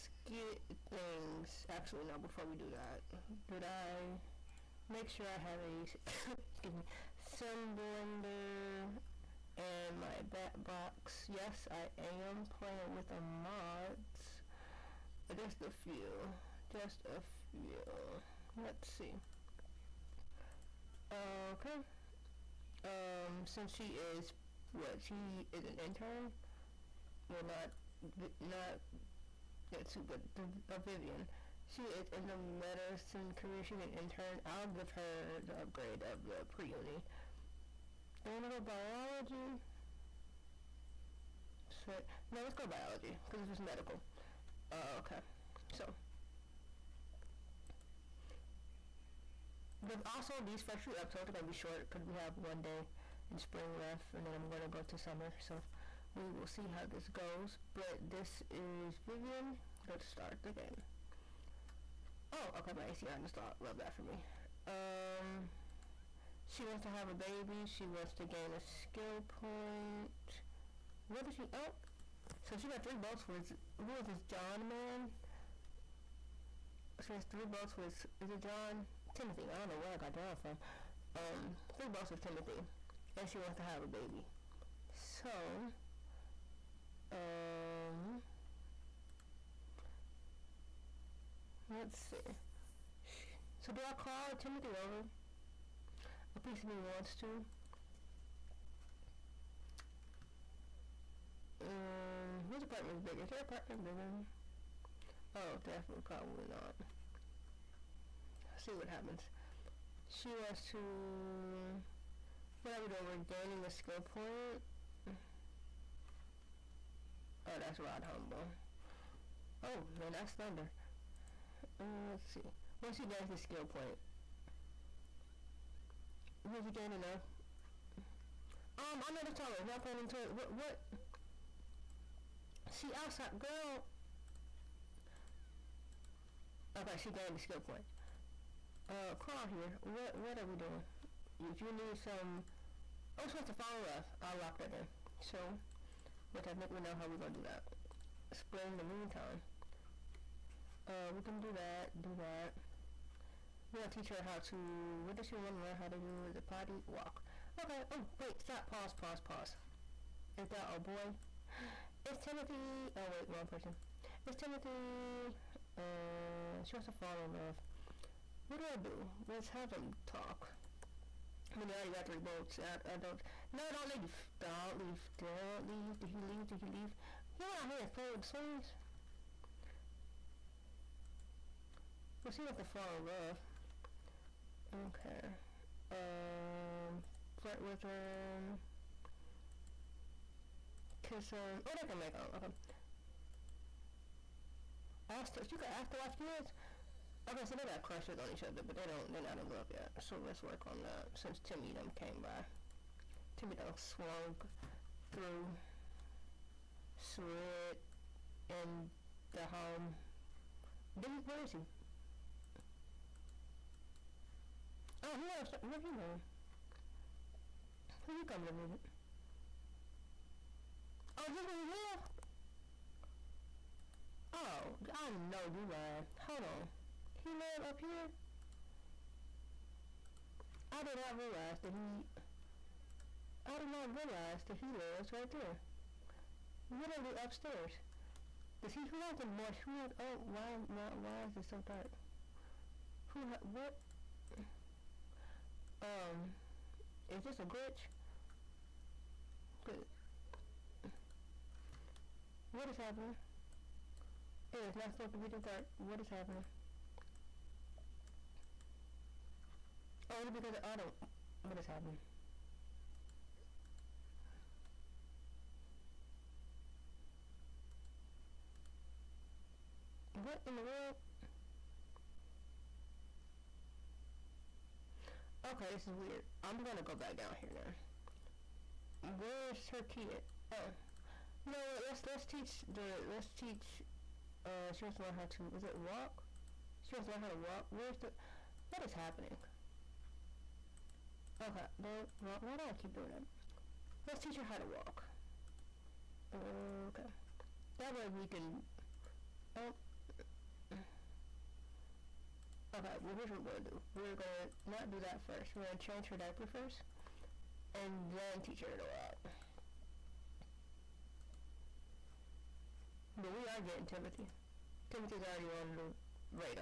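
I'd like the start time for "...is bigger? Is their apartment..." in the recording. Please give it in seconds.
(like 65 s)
102 s.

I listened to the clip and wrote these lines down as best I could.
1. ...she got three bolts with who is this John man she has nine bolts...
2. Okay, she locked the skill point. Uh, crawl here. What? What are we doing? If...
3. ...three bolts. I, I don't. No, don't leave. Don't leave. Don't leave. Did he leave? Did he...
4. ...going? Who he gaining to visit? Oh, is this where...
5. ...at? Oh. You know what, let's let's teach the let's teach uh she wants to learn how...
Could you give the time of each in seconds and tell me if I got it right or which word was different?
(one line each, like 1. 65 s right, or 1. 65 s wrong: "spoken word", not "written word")
1. 72 s wrong: "three", not "nine"
2. 136 s wrong: "gained", not "locked"
3. 172 s right
4. 215 s wrong: "coming", not "gaining"
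5. 280 s right.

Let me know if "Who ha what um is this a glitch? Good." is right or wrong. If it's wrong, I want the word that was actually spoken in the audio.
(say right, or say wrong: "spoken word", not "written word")
right.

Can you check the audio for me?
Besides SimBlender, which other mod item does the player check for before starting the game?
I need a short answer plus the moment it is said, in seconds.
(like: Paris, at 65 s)
bat box, at 10 s.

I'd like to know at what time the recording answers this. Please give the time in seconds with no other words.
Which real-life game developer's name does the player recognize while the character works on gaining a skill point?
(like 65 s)
117 s.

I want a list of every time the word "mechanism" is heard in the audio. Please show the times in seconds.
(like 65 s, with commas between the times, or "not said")
not said.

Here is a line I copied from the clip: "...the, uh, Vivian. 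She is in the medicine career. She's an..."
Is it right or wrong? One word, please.
right.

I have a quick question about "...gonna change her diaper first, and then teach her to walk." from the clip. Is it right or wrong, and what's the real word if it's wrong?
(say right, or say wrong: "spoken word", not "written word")
right.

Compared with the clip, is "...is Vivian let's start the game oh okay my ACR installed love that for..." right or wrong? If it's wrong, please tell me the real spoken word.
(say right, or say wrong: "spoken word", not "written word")
right.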